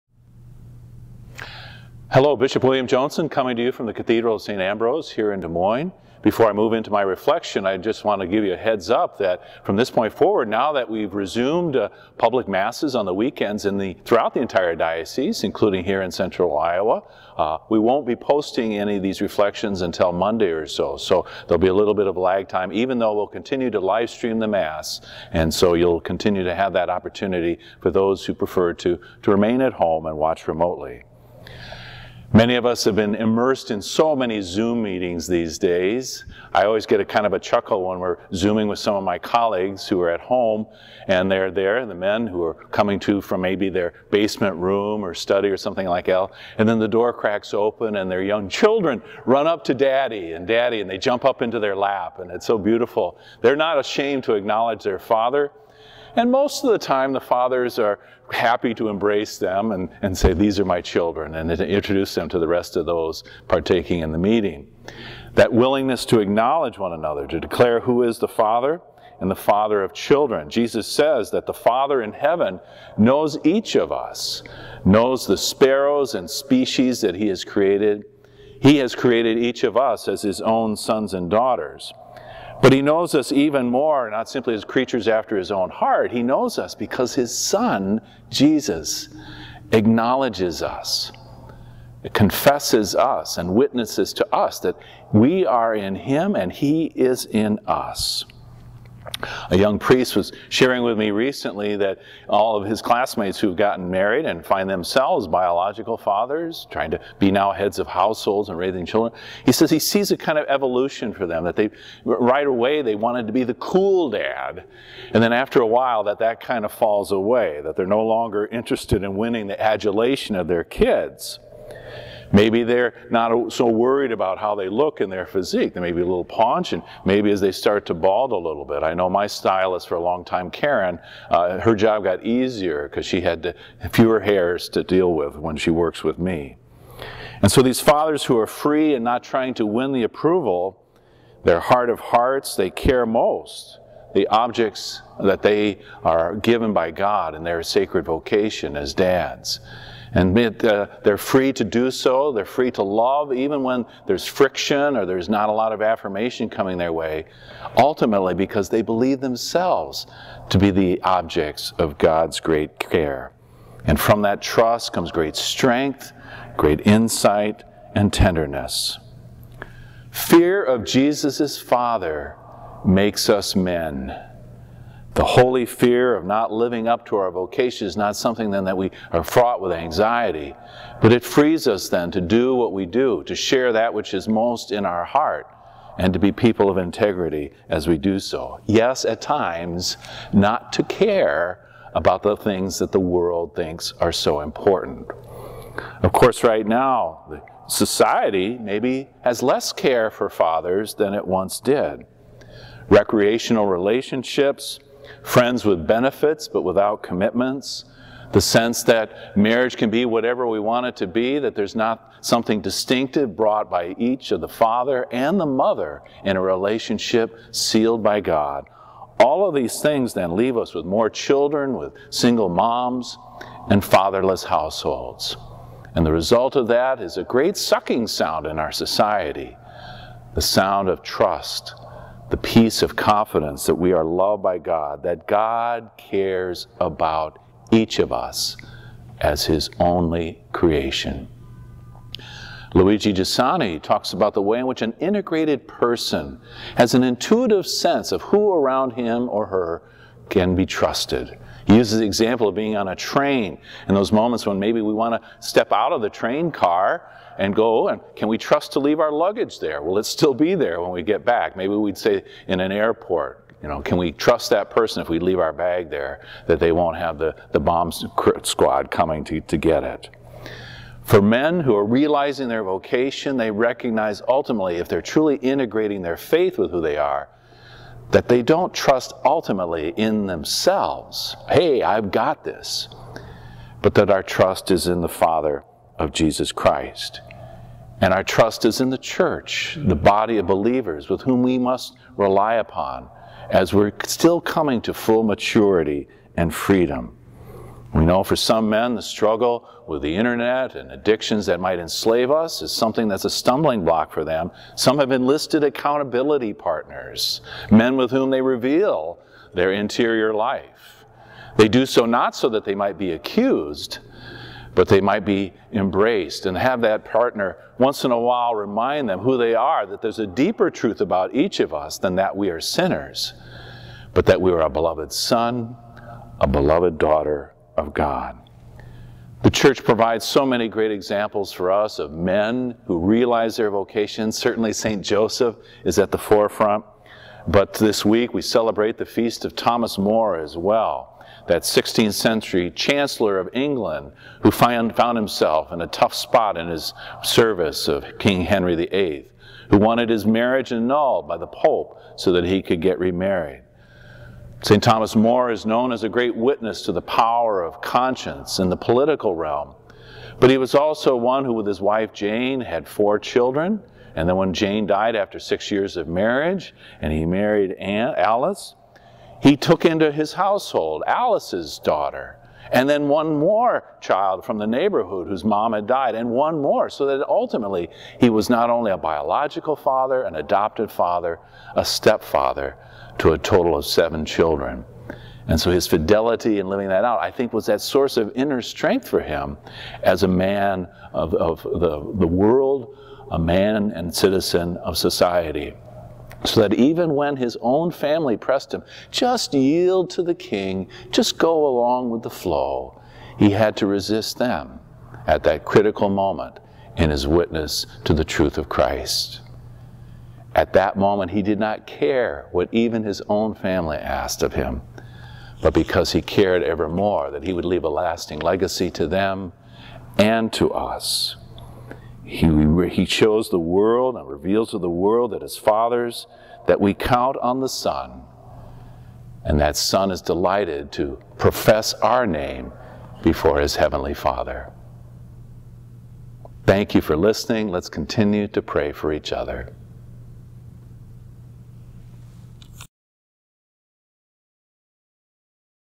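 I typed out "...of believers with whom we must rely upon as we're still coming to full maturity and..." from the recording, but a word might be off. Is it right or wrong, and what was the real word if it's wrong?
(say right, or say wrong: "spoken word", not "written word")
right.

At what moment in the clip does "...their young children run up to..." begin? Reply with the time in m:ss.
0:48.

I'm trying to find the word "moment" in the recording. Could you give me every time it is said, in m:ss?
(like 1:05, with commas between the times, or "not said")
4:14, 6:46, 6:50.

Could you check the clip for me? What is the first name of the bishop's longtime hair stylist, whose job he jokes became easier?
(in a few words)
Karen.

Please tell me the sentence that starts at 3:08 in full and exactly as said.
Yes, at times, not to care about the things that the world thinks are so important.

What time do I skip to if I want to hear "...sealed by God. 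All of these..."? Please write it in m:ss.
3:37.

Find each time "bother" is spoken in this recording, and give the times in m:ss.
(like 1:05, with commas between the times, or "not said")
not said.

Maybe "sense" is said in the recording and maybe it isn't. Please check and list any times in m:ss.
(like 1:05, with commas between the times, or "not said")
3:28, 4:07.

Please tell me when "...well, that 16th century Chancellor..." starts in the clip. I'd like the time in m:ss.
5:40.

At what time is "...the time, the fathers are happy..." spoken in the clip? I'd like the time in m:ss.
0:56.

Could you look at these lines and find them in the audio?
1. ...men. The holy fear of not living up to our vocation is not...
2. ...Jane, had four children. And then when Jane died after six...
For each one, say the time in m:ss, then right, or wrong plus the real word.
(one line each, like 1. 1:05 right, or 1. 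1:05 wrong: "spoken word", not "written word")
1. 2:53 right
2. 6:02 right.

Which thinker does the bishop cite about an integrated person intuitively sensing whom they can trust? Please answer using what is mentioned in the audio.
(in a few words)
Luigi Giussani.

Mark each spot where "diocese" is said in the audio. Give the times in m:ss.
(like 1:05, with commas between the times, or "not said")
0:14.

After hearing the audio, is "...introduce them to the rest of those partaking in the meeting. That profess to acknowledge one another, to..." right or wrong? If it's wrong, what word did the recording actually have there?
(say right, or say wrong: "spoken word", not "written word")
wrong: "willingness", not "profess".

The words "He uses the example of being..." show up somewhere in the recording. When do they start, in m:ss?
4:11.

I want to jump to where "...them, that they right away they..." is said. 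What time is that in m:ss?
1:51.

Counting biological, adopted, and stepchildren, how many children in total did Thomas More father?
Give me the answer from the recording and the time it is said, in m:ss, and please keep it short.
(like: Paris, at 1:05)
7, at 6:23.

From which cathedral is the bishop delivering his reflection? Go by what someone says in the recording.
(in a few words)
Cathedral of St. Ambrose.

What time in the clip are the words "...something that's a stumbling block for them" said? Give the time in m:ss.
5:02.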